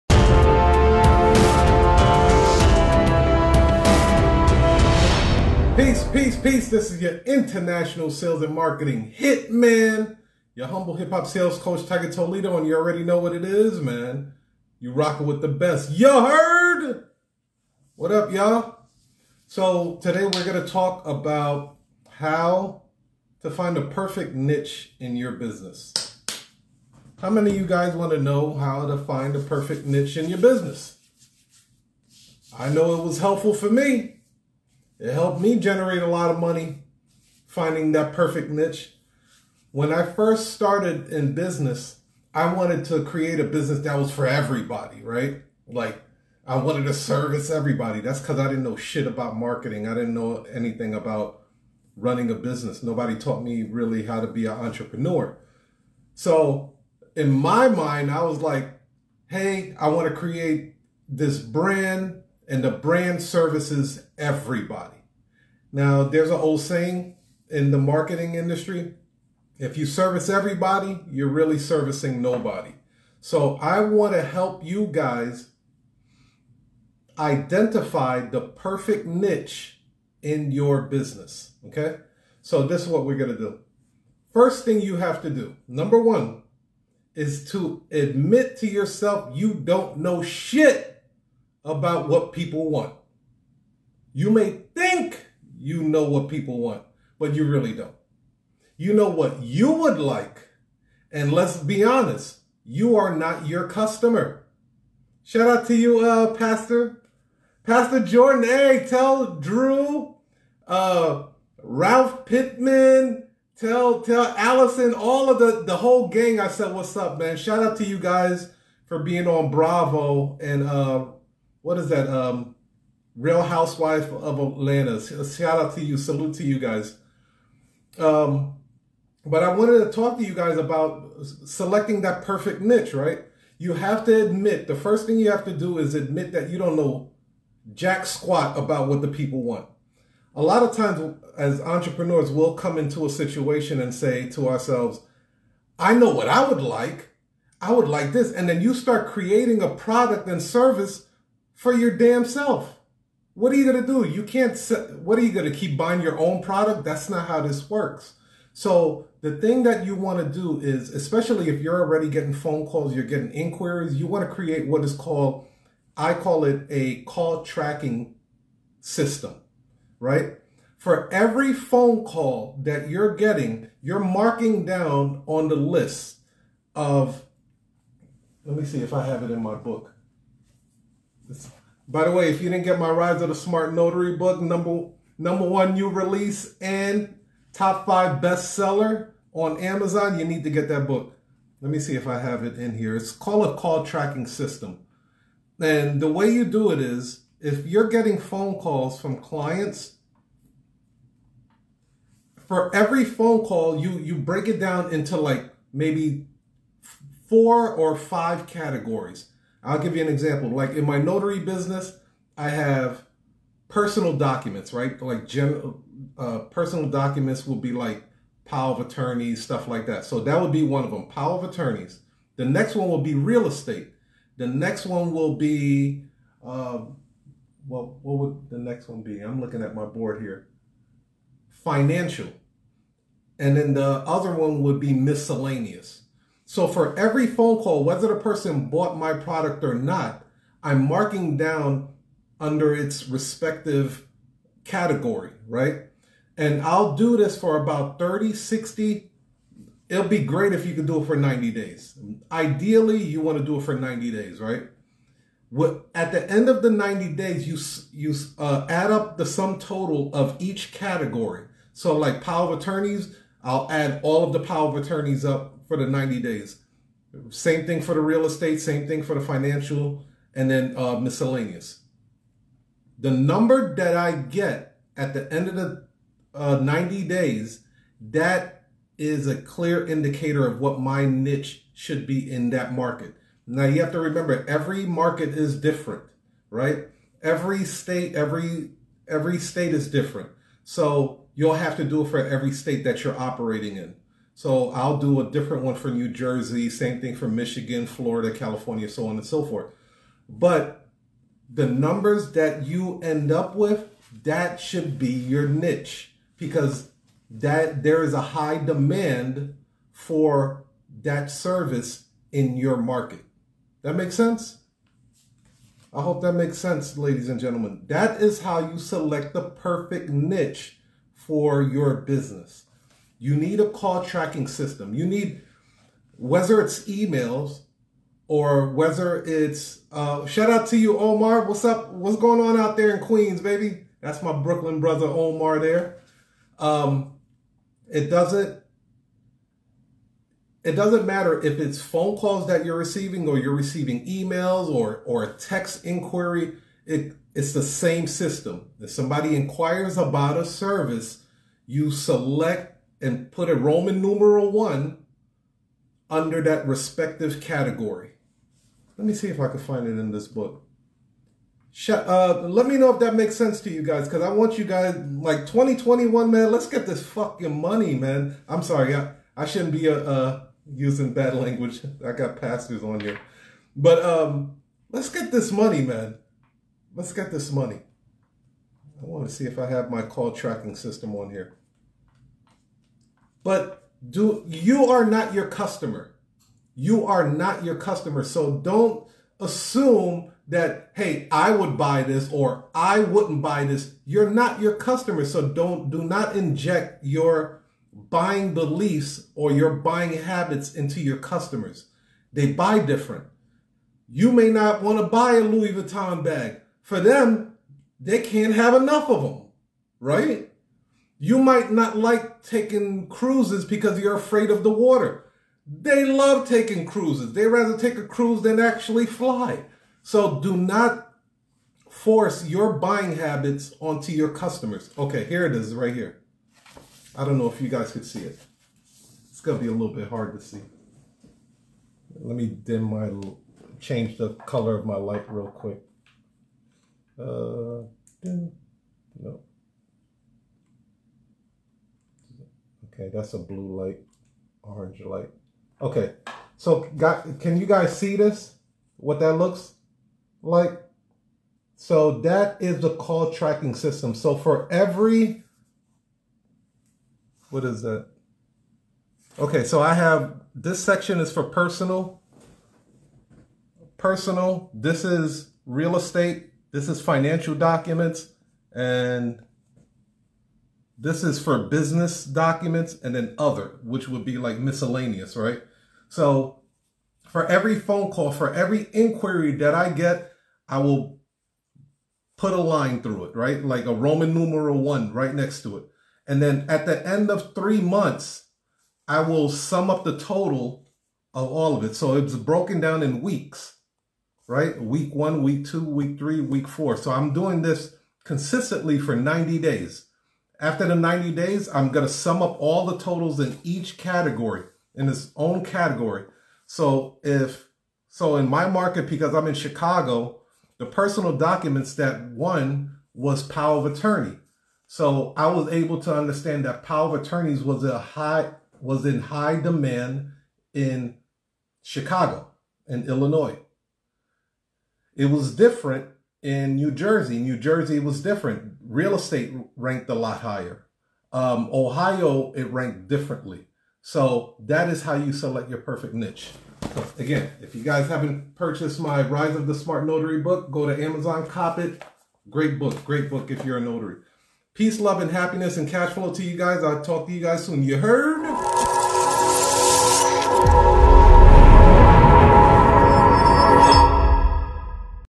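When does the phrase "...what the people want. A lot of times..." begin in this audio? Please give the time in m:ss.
2:18.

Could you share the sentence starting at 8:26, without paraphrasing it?
So if, so in my market, because I'm in Chicago, the personal documents that won was power of attorney.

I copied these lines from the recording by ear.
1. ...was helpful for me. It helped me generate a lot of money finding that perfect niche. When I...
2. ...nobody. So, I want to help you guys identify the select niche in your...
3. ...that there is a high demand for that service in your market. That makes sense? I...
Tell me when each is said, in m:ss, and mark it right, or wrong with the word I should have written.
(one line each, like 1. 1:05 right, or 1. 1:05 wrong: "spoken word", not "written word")
1. 0:33 right
2. 1:12 wrong: "perfect", not "select"
3. 5:07 right.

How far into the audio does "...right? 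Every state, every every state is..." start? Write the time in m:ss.
4:46.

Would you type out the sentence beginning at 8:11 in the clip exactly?
So it's broken down in weeks, right?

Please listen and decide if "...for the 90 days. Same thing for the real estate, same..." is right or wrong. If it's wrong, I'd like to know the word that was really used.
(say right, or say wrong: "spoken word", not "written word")
right.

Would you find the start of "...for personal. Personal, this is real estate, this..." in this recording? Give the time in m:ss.
7:41.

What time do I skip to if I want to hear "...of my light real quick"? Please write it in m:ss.
7:14.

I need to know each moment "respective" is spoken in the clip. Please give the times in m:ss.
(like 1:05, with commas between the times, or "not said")
4:03, 5:56.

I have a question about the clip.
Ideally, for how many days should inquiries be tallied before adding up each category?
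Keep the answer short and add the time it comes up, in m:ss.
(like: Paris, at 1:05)
90, at 4:12.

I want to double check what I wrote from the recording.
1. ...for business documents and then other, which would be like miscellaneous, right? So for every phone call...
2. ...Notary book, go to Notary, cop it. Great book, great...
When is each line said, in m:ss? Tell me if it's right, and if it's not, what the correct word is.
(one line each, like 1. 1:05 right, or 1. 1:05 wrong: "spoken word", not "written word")
1. 7:51 right
2. 9:00 wrong: "Amazon", not "Notary".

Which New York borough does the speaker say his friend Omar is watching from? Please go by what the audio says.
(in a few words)
Queens.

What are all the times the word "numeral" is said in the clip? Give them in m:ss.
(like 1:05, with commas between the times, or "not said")
5:54, 8:04.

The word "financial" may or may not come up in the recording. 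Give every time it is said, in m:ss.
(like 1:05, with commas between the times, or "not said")
3:51, 4:29, 7:47.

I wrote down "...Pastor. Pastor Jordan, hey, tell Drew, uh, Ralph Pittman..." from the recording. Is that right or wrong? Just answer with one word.
right.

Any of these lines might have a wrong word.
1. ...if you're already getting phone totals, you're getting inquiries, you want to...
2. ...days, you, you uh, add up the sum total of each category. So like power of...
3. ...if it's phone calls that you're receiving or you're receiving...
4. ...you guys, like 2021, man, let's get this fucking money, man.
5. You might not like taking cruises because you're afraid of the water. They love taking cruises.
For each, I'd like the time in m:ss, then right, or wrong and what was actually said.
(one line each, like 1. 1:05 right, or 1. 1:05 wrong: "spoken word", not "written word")
1. 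2:41 wrong: "calls", not "totals"
2. 4:17 right
3. 5:41 right
4. 6:04 right
5. 6:51 right.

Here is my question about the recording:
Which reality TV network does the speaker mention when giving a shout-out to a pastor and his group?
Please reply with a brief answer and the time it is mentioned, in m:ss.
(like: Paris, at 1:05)
Bravo, at 1:59.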